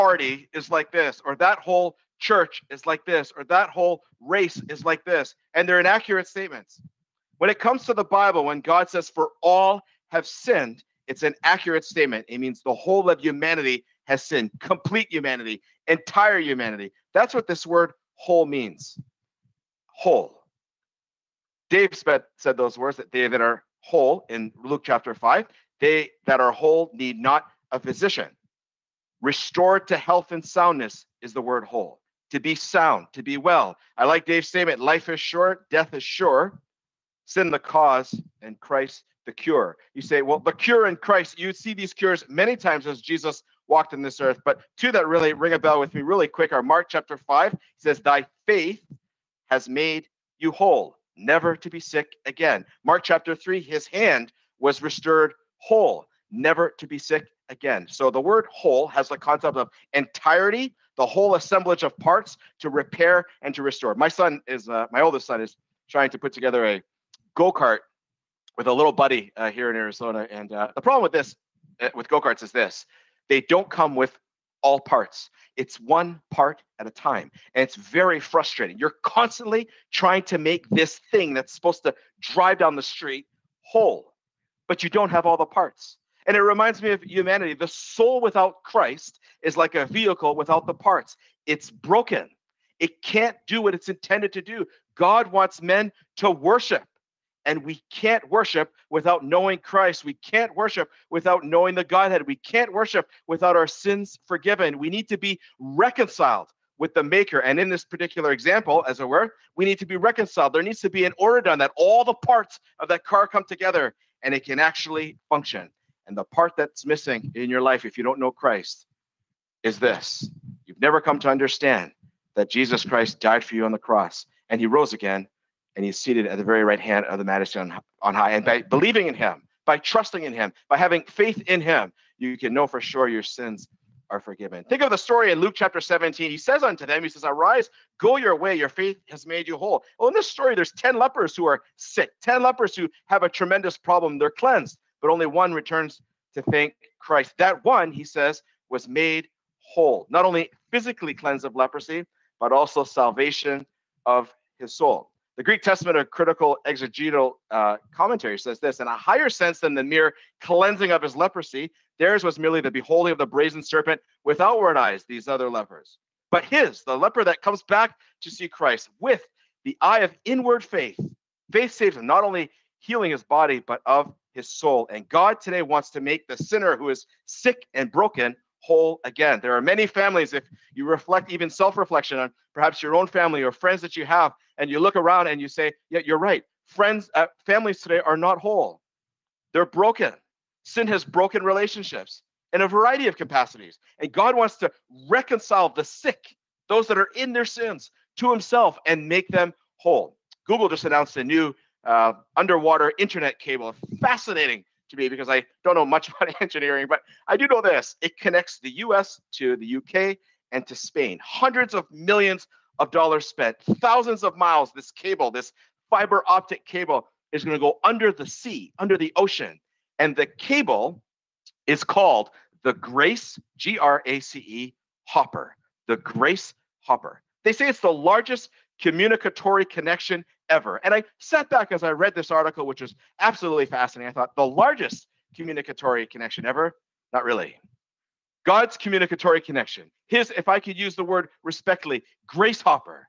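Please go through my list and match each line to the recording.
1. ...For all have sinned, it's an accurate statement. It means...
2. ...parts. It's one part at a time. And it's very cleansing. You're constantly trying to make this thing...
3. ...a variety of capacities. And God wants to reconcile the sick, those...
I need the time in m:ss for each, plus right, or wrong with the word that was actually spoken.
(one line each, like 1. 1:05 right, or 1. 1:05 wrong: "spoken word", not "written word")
1. 0:09 right
2. 1:14 wrong: "frustrating", not "cleansing"
3. 3:12 right.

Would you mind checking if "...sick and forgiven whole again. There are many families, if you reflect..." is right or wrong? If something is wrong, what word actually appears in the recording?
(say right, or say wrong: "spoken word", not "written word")
wrong: "broken", not "forgiven".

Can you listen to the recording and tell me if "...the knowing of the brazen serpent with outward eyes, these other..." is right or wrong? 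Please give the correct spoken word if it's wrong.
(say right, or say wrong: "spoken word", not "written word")
wrong: "beholding", not "knowing".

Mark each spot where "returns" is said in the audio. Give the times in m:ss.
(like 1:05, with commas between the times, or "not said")
2:25.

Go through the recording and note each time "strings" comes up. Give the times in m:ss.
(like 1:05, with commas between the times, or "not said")
not said.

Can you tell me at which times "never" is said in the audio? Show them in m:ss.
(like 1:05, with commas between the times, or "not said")
0:51, 0:56, 2:00.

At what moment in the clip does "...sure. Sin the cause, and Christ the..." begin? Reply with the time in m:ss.
0:36.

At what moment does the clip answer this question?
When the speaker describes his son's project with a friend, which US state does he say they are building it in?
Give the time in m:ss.
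1:09.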